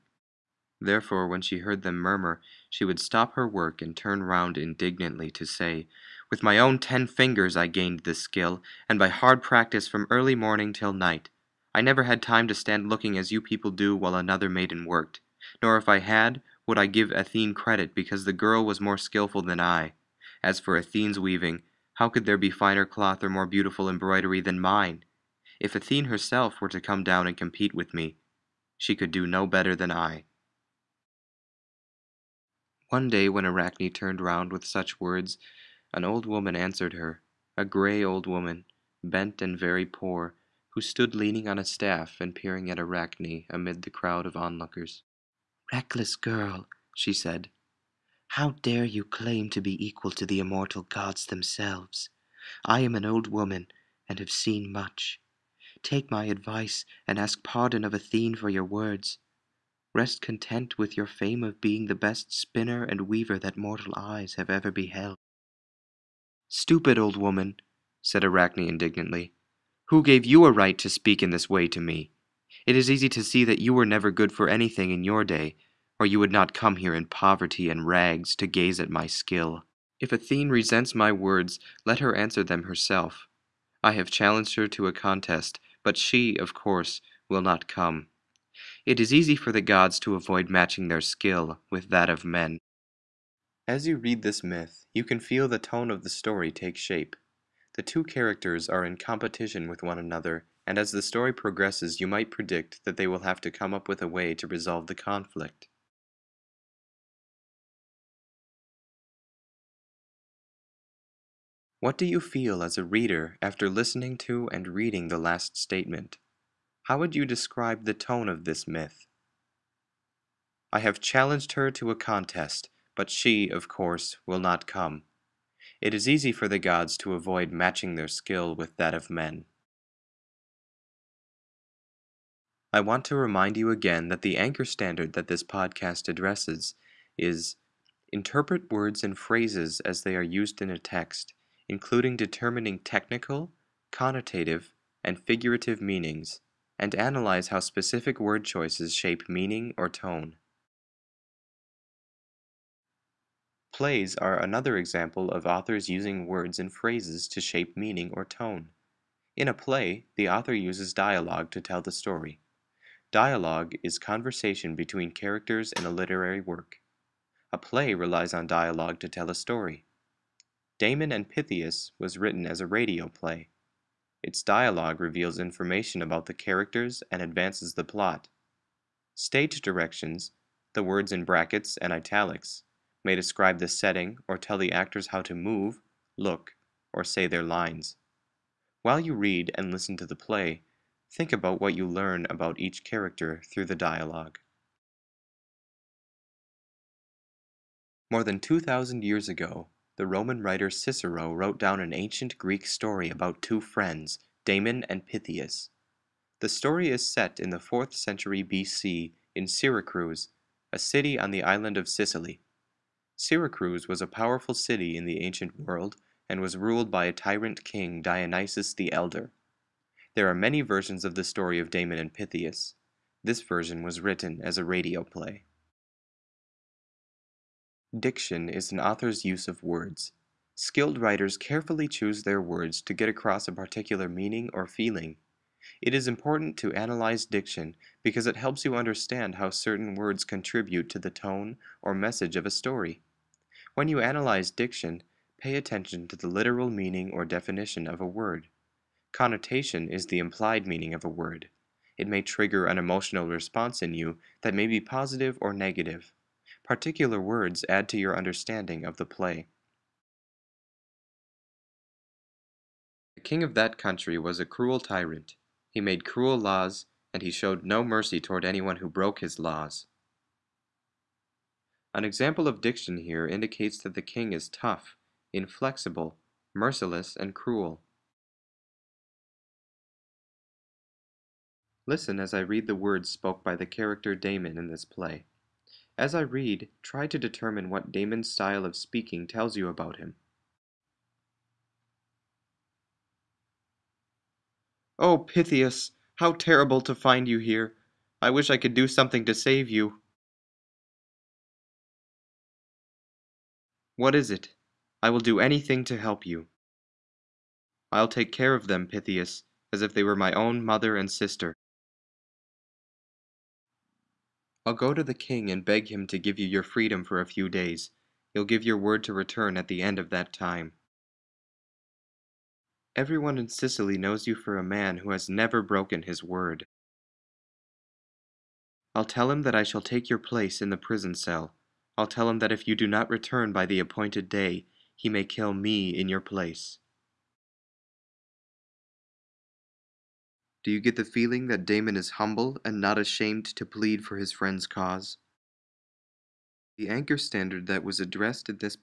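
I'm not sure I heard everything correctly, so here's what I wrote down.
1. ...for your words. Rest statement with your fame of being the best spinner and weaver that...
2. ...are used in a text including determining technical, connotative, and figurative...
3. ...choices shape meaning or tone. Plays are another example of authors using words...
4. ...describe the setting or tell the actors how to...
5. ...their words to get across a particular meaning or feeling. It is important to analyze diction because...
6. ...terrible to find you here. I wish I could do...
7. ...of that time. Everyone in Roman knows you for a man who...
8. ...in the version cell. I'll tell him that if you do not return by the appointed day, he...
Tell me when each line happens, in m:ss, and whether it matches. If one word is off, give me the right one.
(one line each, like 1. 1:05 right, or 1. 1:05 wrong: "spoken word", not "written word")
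1. 0:58 wrong: "content", not "statement"
2. 2:20 right
3. 2:28 right
4. 3:03 right
5. 3:52 right
6. 4:56 right
7. 5:19 wrong: "Sicily", not "Roman"
8. 5:30 wrong: "prison", not "version".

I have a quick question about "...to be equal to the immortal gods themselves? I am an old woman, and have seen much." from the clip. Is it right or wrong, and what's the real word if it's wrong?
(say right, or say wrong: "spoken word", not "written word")
right.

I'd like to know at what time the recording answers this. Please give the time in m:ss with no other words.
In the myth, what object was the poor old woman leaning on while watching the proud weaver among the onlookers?
0:41.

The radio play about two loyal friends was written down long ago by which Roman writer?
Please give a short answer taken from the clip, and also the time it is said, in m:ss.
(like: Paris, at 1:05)
Cicero, at 3:20.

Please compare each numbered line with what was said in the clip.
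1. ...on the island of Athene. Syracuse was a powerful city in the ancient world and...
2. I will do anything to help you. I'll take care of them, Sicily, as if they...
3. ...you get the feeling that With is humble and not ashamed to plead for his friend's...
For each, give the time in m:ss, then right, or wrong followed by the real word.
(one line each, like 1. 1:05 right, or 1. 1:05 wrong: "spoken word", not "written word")
1. 3:31 wrong: "Sicily", not "Athene"
2. 5:05 wrong: "Pythias", not "Sicily"
3. 5:40 wrong: "Damon", not "With".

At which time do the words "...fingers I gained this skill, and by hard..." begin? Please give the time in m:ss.
0:07.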